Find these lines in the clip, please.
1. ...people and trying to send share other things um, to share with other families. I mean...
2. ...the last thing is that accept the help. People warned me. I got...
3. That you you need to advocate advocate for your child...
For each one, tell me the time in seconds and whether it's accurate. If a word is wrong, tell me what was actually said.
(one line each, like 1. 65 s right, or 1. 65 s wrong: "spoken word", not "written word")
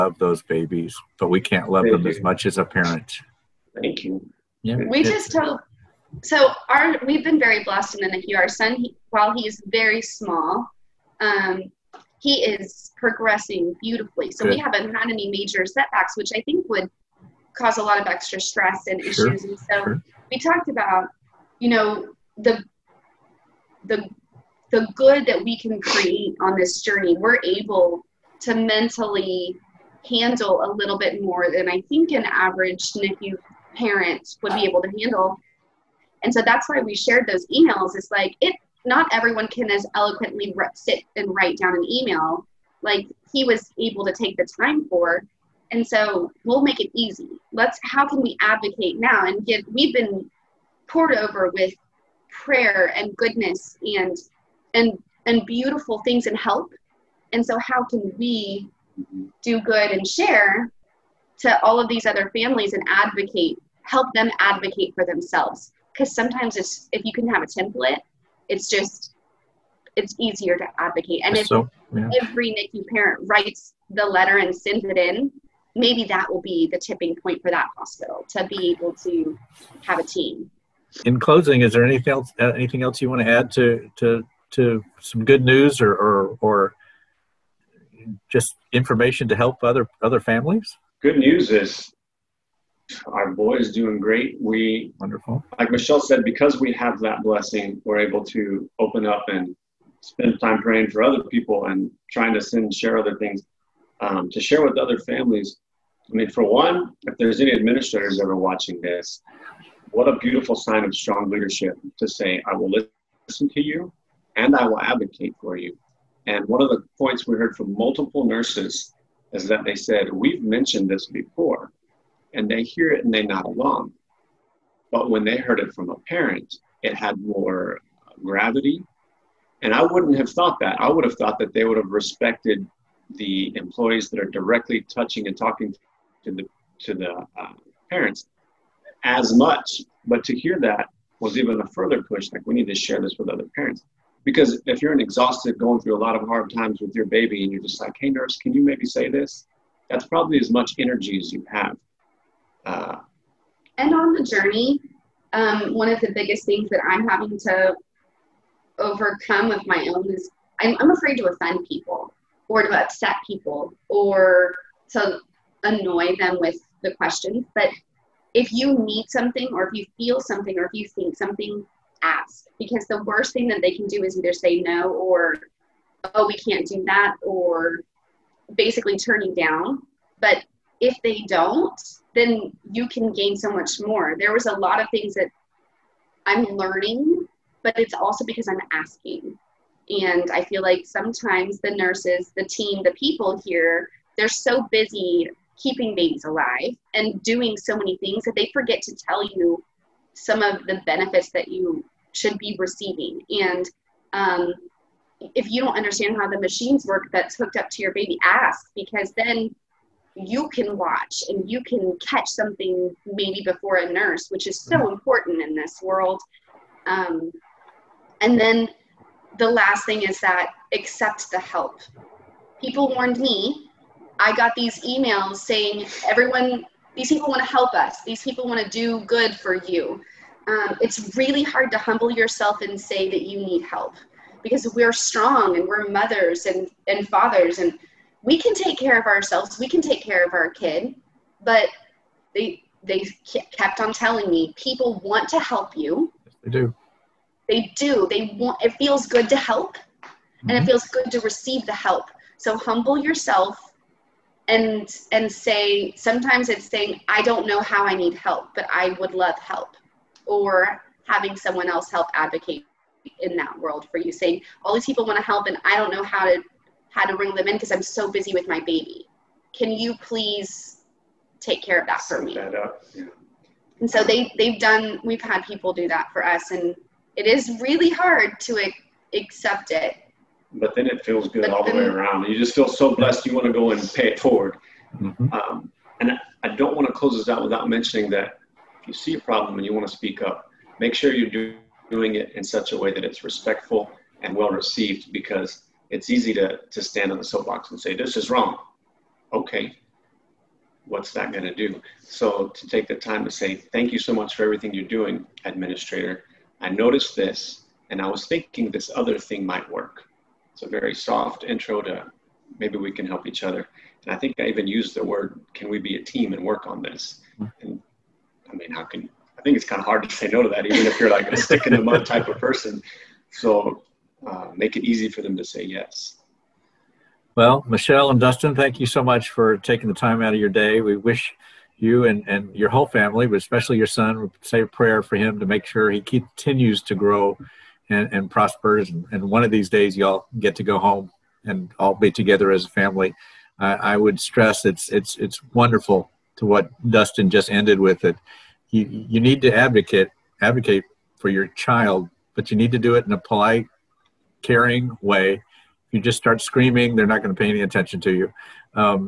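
1. 101 s right
2. 219 s right
3. 348 s right.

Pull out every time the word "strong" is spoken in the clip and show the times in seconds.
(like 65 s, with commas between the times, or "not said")
110 s, 234 s.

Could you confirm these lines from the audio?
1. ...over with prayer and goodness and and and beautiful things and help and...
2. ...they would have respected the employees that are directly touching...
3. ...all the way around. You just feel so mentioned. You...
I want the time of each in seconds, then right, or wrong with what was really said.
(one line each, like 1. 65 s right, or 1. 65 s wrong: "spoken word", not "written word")
1. 51 s right
2. 131 s right
3. 281 s wrong: "blessed", not "mentioned".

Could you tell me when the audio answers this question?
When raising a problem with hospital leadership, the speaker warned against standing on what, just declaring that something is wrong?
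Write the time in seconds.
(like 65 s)
297 s.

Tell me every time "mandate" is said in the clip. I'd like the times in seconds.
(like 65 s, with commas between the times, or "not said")
not said.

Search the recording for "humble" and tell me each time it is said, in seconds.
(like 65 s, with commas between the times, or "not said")
231 s, 252 s.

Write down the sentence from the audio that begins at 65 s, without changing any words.
Because sometimes it's, if you can have a template, it's just, it's easier to advocate.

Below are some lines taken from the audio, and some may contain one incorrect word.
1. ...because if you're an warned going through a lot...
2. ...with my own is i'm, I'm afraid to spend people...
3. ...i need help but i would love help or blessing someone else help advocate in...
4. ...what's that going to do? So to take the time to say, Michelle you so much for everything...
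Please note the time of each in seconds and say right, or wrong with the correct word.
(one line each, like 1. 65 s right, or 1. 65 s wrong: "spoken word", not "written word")
1. 144 s wrong: "exhausted", not "warned"
2. 159 s wrong: "offend", not "spend"
3. 257 s wrong: "having", not "blessing"
4. 300 s wrong: "Thank", not "Michelle".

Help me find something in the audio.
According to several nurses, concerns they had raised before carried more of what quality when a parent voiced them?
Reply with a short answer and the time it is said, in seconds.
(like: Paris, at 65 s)
Gravity, at 128 s.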